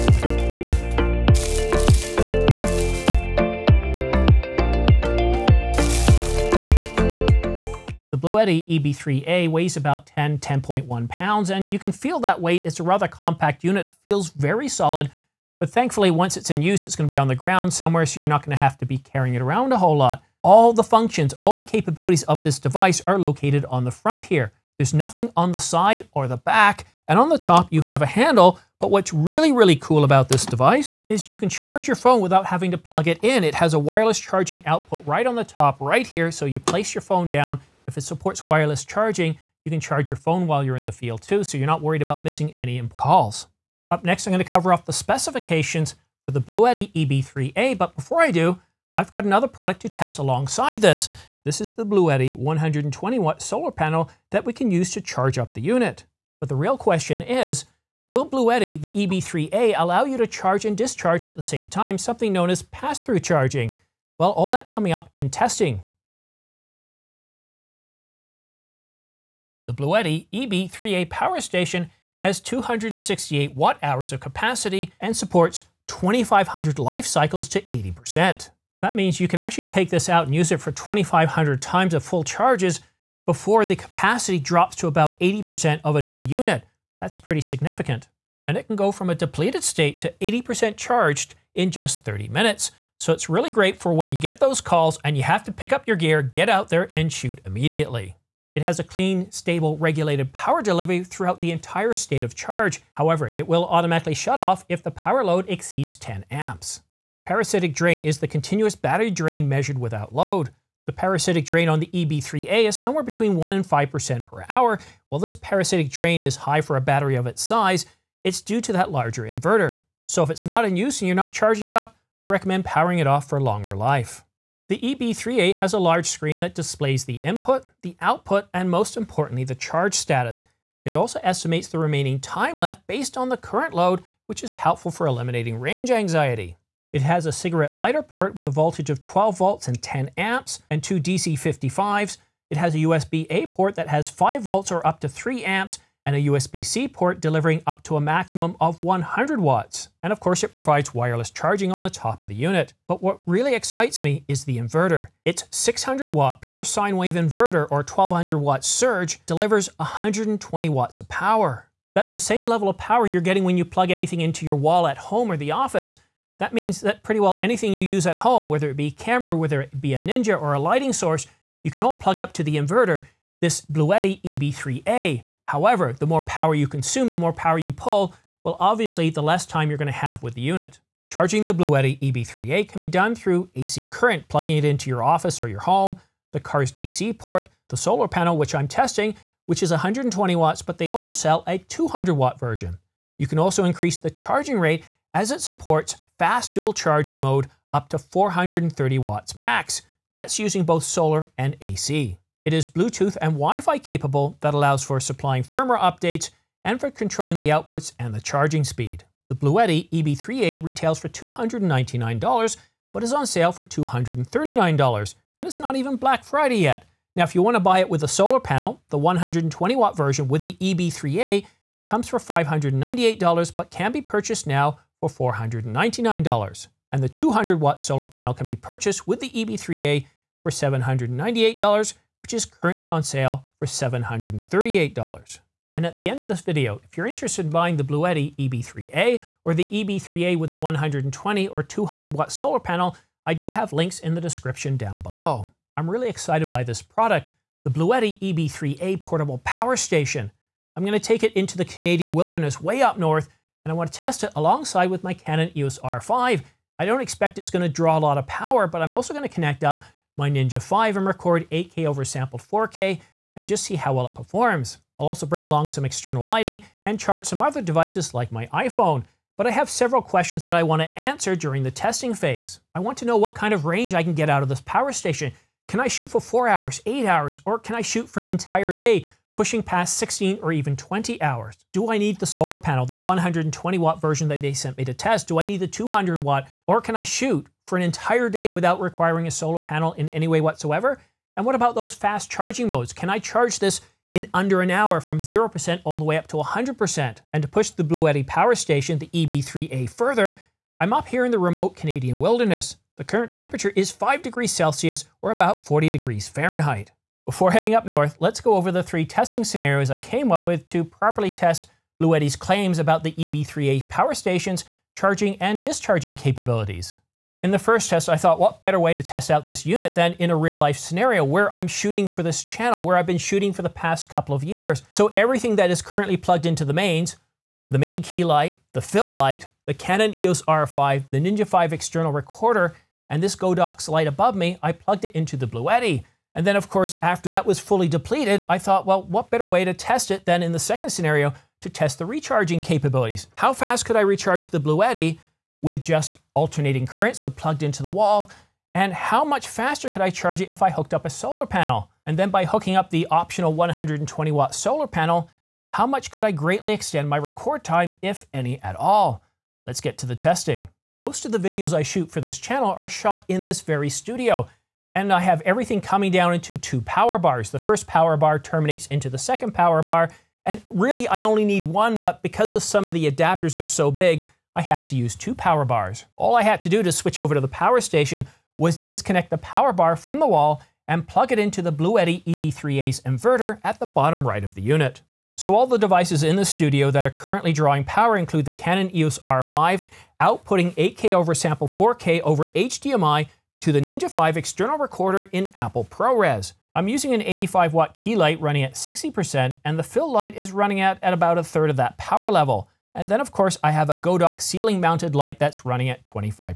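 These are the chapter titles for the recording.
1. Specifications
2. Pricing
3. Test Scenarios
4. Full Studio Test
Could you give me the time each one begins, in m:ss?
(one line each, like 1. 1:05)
1. 1:06
2. 3:22
3. 5:16
4. 6:00.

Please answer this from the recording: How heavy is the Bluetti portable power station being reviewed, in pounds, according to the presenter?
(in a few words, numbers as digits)
10.1 pounds.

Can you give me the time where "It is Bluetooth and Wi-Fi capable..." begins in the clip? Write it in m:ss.
3:22.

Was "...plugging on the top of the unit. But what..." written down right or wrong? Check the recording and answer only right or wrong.
wrong.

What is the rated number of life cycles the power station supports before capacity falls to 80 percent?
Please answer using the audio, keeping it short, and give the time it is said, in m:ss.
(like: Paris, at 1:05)
2,500, at 1:15.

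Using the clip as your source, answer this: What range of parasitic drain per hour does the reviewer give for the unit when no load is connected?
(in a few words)
1 to 5%.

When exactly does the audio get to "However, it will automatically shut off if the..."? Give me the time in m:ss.
1:42.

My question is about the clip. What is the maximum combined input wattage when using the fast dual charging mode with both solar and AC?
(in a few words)
430 watts.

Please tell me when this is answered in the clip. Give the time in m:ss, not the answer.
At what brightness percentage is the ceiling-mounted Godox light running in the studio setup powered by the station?
6:46.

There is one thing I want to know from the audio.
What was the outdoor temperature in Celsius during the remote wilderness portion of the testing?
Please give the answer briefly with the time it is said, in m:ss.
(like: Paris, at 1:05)
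5 degrees Celsius, at 5:03.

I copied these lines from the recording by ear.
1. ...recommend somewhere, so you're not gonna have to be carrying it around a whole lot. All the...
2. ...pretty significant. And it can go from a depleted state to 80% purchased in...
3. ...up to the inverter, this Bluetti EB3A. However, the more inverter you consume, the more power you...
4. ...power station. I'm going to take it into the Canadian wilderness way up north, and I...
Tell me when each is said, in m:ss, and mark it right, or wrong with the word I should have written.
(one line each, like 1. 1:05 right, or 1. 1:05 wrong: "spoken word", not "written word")
1. 0:17 wrong: "ground", not "recommend"
2. 1:27 wrong: "charged", not "purchased"
3. 2:52 wrong: "power", not "inverter"
4. 4:09 right.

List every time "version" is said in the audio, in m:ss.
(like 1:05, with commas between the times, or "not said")
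3:12, 3:39, 4:43.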